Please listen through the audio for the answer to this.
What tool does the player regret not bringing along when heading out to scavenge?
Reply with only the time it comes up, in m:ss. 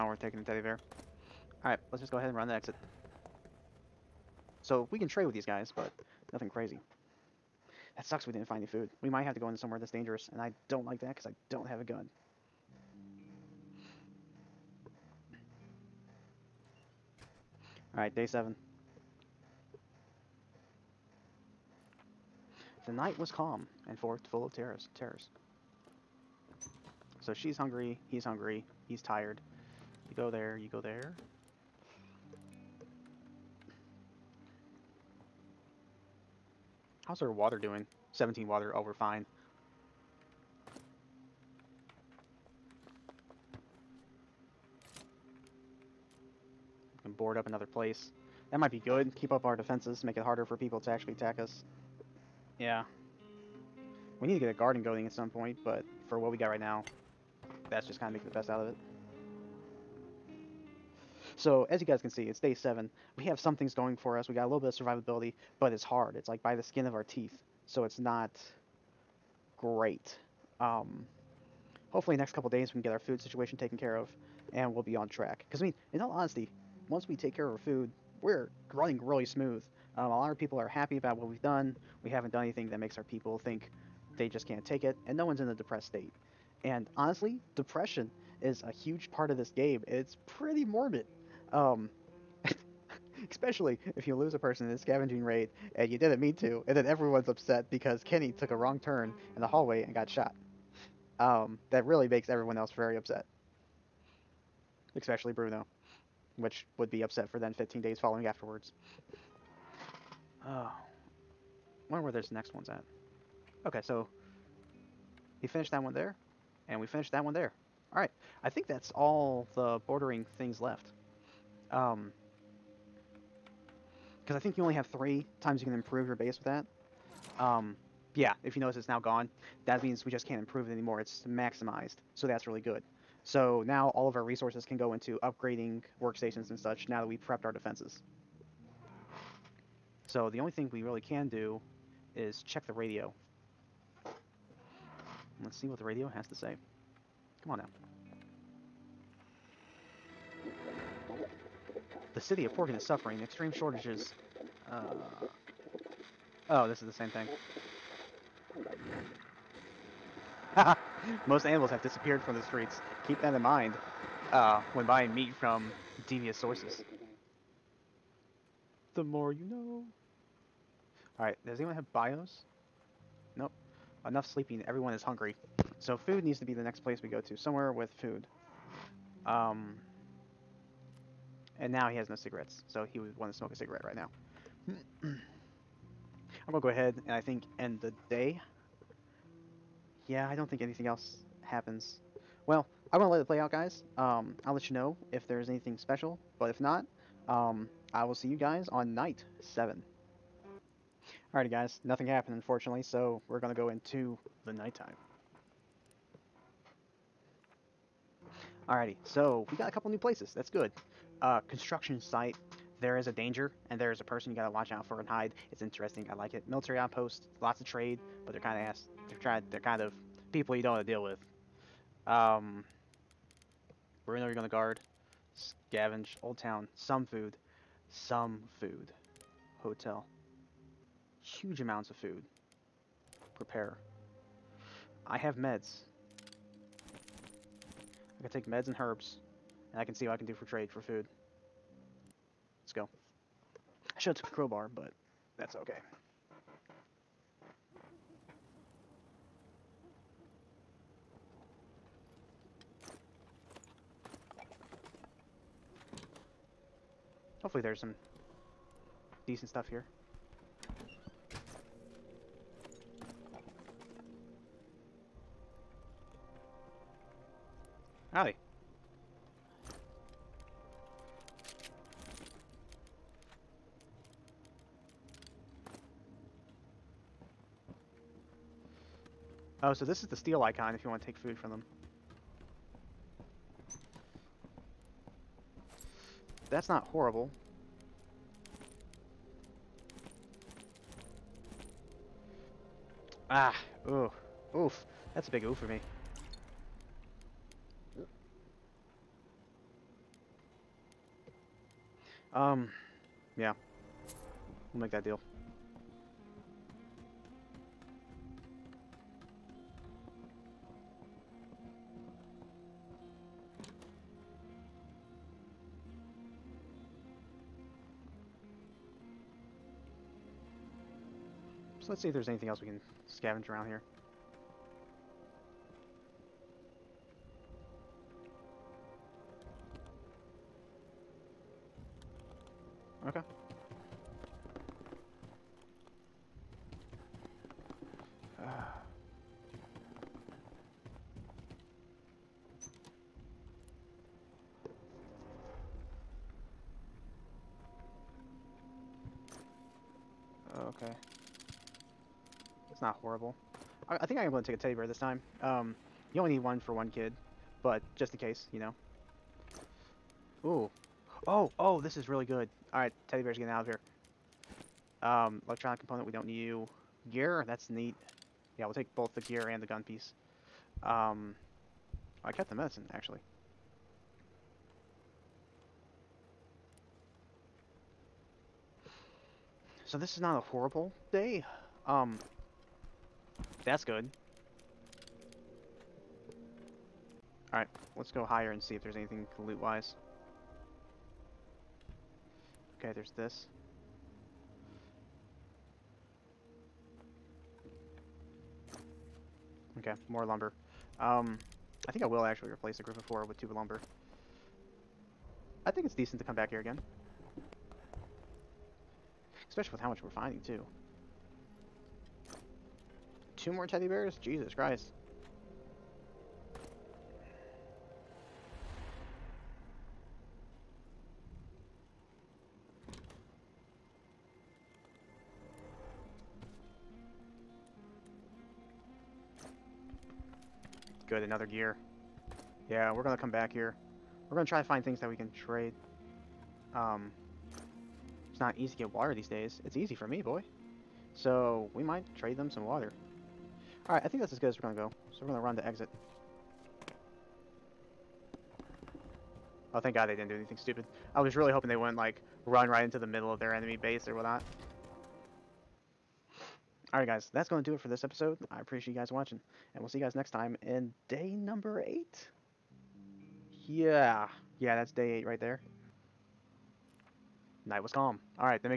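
4:04.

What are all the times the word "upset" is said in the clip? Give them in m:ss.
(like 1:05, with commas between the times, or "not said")
1:37, 1:42, 1:47.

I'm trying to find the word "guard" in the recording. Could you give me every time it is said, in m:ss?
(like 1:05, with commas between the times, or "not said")
3:44.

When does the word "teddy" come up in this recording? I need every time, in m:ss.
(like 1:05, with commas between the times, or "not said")
0:00, 5:54, 6:03, 6:53.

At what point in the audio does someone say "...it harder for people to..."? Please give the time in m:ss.
0:50.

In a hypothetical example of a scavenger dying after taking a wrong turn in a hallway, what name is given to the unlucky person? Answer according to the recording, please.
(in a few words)
Kenny.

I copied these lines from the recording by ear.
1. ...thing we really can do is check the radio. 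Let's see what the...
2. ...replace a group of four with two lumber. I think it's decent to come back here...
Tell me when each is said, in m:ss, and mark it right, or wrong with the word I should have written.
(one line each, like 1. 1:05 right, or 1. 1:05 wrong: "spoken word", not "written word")
1. 2:20 right
2. 6:42 right.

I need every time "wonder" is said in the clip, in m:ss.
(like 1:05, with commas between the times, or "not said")
1:51.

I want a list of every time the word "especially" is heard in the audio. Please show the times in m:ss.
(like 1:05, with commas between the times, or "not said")
1:33, 1:44, 6:49.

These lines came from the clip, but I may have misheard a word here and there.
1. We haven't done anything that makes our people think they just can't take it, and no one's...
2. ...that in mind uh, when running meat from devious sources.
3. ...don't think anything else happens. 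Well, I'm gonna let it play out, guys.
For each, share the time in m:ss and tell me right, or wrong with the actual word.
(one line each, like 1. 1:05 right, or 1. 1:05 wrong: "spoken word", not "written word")
1. 1:22 right
2. 2:43 wrong: "buying", not "running"
3. 3:10 right.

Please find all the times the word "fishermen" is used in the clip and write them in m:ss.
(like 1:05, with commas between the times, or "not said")
not said.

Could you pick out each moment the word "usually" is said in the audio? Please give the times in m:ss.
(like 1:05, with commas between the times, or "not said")
not said.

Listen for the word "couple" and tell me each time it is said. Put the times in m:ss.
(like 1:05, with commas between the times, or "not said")
1:12, 3:29.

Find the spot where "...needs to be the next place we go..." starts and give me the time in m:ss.
2:56.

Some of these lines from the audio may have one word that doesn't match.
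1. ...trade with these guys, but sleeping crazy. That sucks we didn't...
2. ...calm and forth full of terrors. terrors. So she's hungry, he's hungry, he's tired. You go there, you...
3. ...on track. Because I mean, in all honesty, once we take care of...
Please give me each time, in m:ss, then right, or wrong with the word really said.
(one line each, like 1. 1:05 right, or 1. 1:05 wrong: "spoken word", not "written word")
1. 0:05 wrong: "nothing", not "sleeping"
2. 0:23 right
3. 1:14 right.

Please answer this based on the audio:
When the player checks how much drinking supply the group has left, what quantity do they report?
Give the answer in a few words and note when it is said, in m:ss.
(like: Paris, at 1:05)
17, at 0:38.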